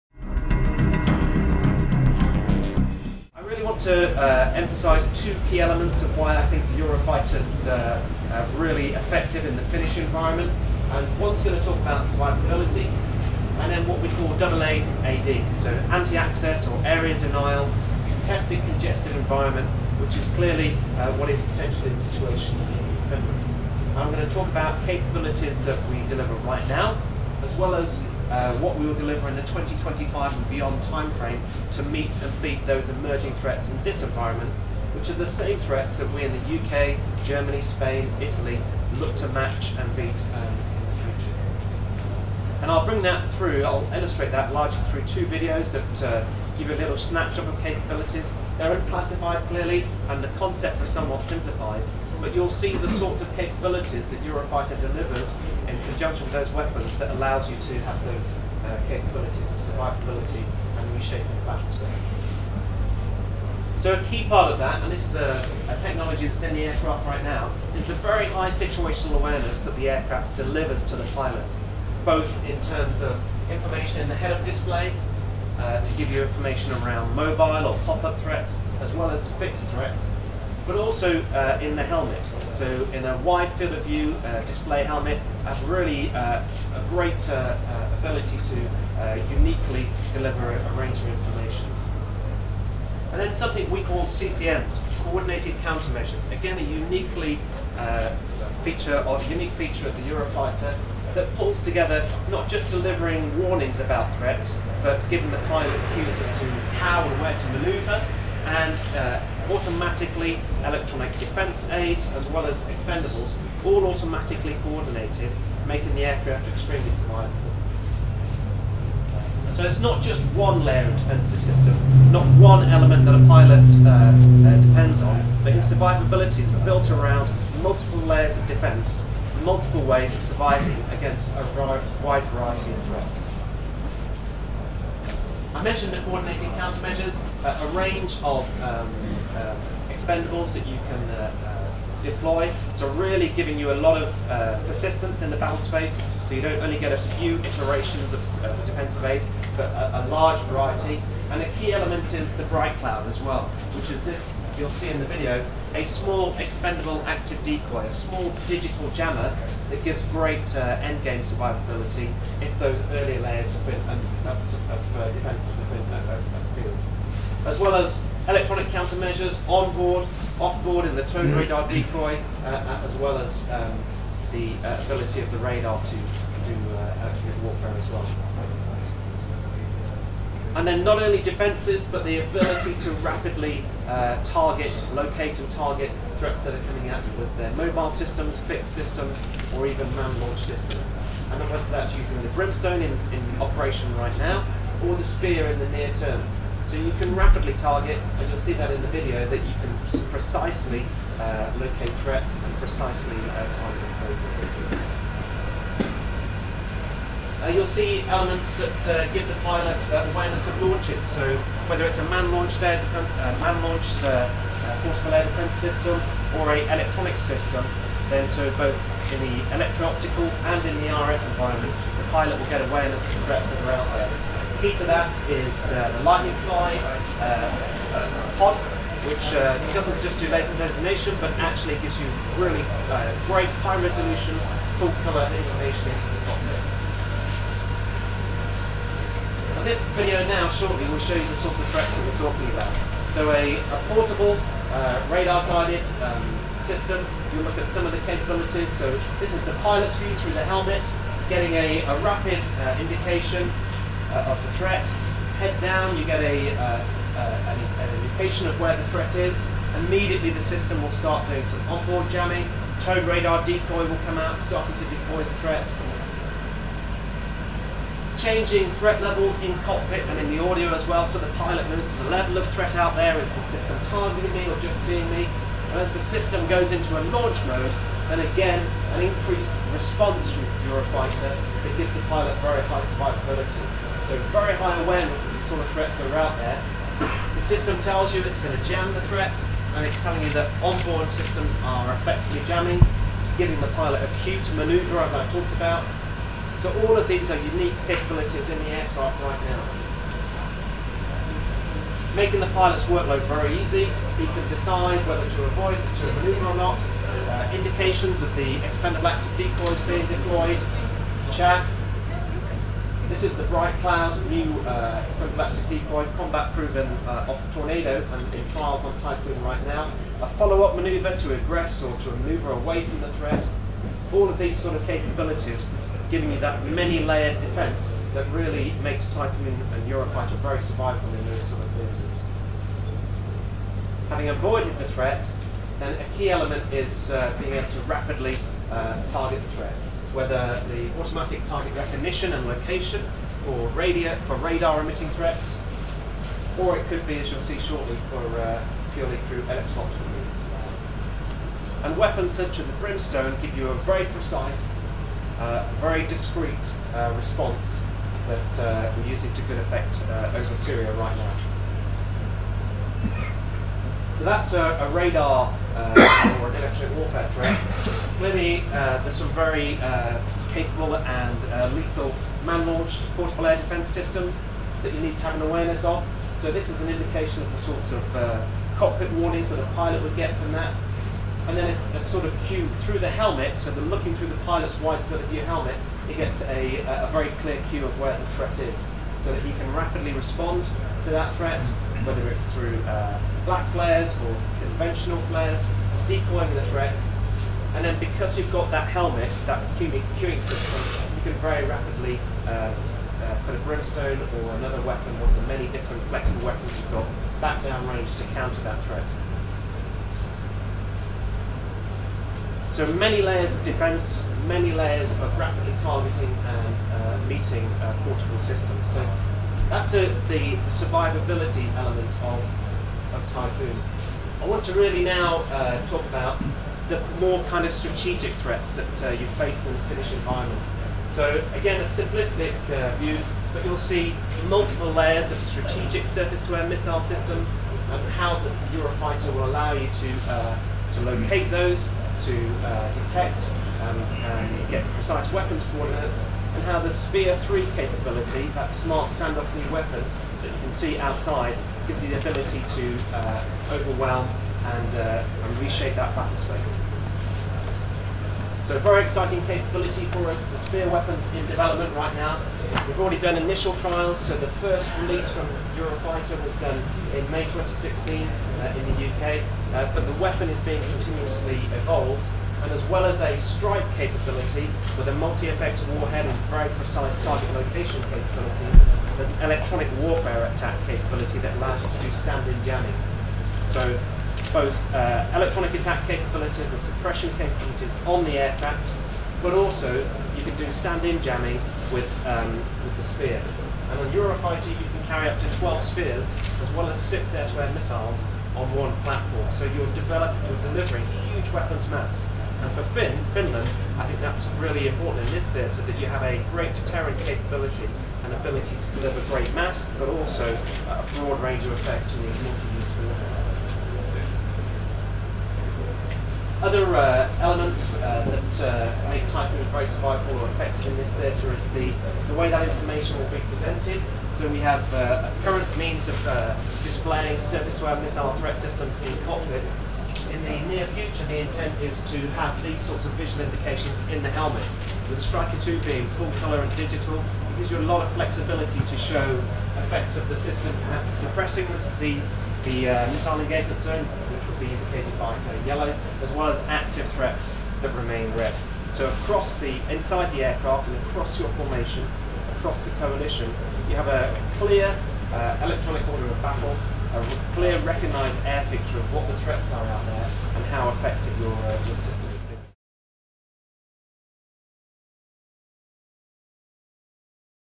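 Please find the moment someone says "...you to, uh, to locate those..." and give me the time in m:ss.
7:19.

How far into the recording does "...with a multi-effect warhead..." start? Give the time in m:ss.
7:54.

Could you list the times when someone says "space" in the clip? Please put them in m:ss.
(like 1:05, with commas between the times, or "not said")
1:01, 2:25, 7:36.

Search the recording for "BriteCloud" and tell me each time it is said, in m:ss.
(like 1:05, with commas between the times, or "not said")
2:32, 5:13.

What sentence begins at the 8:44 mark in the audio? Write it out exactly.
So we have uh, a current means of uh, displaying surface-to-air missile threat systems in cockpit.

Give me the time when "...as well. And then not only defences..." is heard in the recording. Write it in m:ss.
2:57.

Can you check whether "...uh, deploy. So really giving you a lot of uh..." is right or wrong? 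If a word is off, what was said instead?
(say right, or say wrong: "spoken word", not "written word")
right.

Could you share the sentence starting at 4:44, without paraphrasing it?
So very high awareness of the sort of threats that are out there.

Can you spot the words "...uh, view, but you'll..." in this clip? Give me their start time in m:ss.
7:12.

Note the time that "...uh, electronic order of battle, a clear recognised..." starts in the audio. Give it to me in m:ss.
9:15.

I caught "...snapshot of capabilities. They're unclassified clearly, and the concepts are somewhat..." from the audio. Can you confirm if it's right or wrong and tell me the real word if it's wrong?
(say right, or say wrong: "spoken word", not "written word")
right.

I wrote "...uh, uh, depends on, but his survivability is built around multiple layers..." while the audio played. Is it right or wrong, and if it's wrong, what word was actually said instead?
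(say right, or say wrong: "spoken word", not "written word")
right.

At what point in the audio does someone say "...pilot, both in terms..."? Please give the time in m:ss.
1:11.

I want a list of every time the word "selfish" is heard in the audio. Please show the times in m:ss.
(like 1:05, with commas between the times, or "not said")
not said.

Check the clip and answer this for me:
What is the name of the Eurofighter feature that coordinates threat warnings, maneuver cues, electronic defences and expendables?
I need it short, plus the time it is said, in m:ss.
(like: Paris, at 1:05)
Coordinated Countermeasures, at 1:35.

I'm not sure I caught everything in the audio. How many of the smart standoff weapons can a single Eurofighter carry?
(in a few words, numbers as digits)
12.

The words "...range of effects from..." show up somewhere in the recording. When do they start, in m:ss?
8:31.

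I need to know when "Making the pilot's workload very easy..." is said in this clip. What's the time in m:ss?
5:02.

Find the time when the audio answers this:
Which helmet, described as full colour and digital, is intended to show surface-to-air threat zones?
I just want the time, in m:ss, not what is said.
8:55.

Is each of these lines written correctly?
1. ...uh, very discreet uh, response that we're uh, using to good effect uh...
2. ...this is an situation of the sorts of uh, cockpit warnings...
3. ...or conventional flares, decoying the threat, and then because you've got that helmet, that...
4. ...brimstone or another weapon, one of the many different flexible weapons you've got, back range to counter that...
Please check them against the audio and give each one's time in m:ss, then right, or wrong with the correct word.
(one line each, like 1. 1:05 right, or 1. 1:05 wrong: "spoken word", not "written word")
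1. 5:55 right
2. 6:16 wrong: "indication", not "situation"
3. 6:34 right
4. 6:43 wrong: "downrange", not "range".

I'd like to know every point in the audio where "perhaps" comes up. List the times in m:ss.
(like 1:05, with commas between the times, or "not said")
9:00.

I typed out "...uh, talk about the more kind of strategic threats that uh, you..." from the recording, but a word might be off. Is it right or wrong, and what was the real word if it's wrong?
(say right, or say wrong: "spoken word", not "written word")
right.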